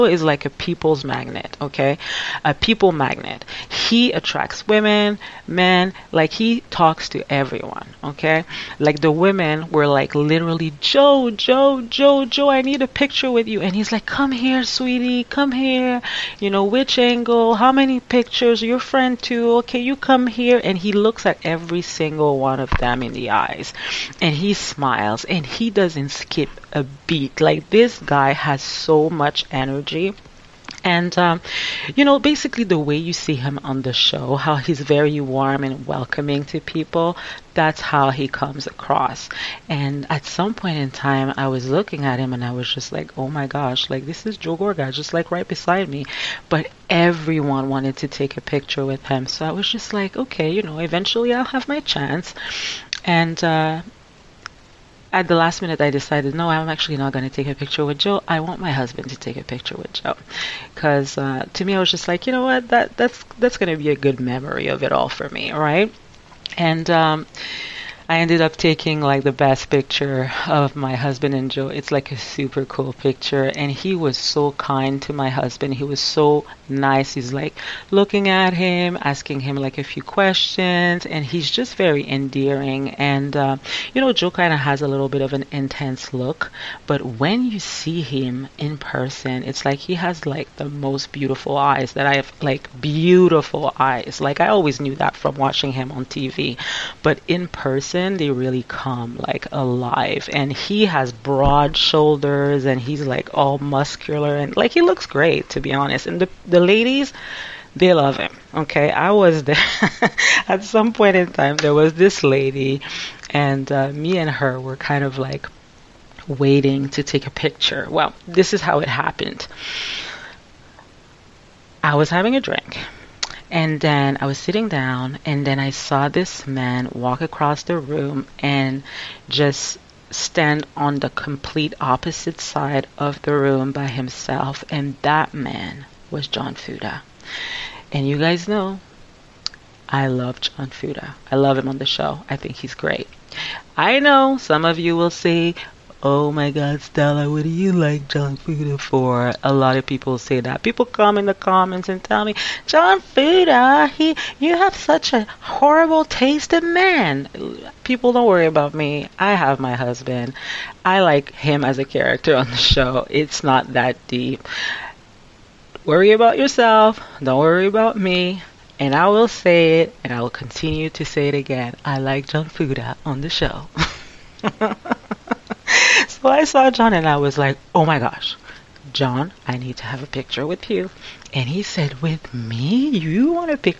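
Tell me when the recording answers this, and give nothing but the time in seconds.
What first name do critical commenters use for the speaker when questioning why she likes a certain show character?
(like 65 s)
146 s.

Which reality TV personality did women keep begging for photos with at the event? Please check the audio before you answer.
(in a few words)
Joe Gorga.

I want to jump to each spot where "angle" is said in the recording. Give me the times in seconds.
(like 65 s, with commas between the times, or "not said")
16 s.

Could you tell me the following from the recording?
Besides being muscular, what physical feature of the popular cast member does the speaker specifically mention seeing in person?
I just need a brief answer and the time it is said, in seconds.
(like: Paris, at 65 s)
Broad shoulders, at 101 s.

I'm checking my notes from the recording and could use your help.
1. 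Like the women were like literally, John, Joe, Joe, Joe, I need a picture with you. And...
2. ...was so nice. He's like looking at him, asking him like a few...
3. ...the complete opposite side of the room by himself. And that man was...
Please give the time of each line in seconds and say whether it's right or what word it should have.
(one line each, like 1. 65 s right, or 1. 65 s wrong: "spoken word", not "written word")
1. 8 s wrong: "Joe", not "John"
2. 75 s right
3. 130 s right.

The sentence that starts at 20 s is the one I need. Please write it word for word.
And he looks at every single one of them in the eyes and he smiles and he doesn't skip a beat.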